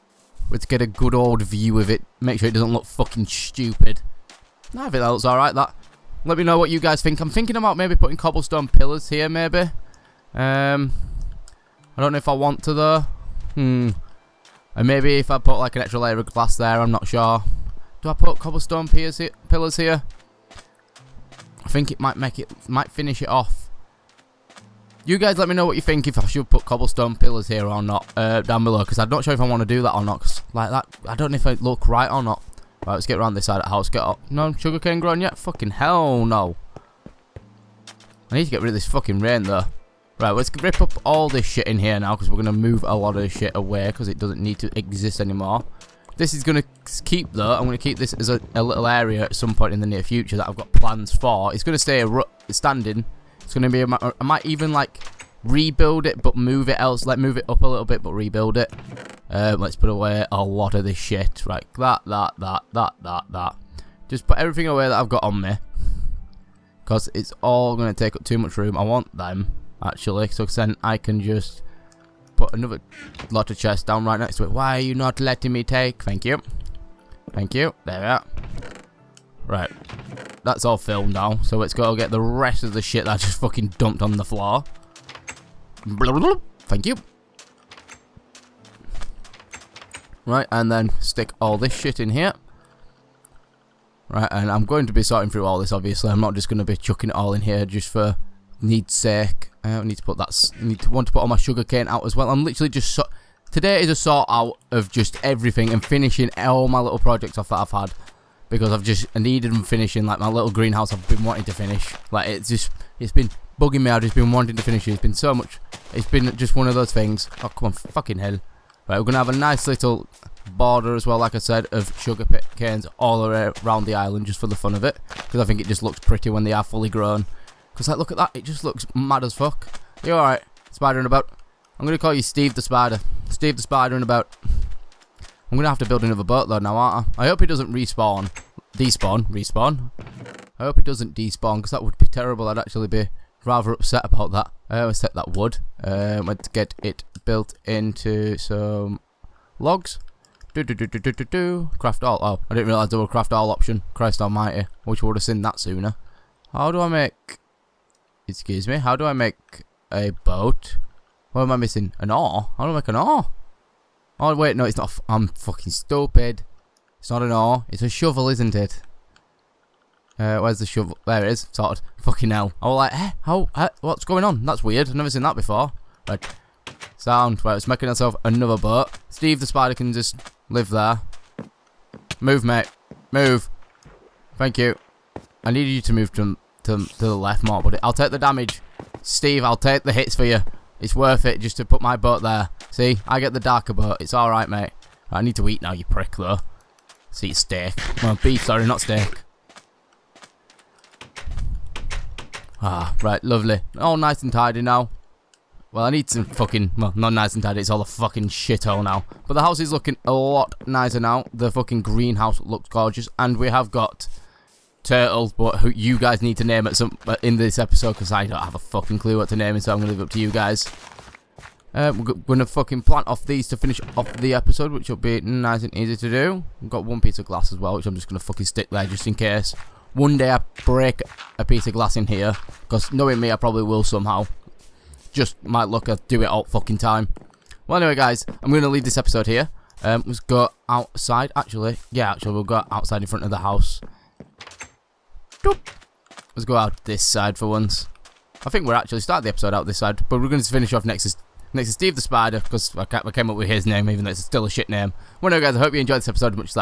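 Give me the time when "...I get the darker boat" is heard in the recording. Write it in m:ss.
3:13.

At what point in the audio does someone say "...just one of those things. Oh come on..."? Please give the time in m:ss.
1:56.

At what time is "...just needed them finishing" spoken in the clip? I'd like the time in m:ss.
1:48.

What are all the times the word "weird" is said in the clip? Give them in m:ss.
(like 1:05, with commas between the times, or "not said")
2:54.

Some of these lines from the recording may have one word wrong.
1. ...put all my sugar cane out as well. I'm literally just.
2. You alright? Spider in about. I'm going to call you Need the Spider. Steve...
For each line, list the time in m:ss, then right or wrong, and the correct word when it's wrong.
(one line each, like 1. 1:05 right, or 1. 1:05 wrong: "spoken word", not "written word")
1. 1:41 right
2. 2:10 wrong: "Steve", not "Need".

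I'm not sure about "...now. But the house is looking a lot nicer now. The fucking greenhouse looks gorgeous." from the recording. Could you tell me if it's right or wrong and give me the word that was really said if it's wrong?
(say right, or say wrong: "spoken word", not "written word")
right.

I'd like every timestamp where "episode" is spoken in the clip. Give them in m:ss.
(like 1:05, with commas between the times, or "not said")
3:37, 3:44, 3:58, 4:09, 4:16.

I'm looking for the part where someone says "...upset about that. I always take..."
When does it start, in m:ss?
2:23.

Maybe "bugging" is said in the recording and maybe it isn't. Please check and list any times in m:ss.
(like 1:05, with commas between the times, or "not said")
1:53.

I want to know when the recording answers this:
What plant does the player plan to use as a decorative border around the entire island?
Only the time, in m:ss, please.
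2:02.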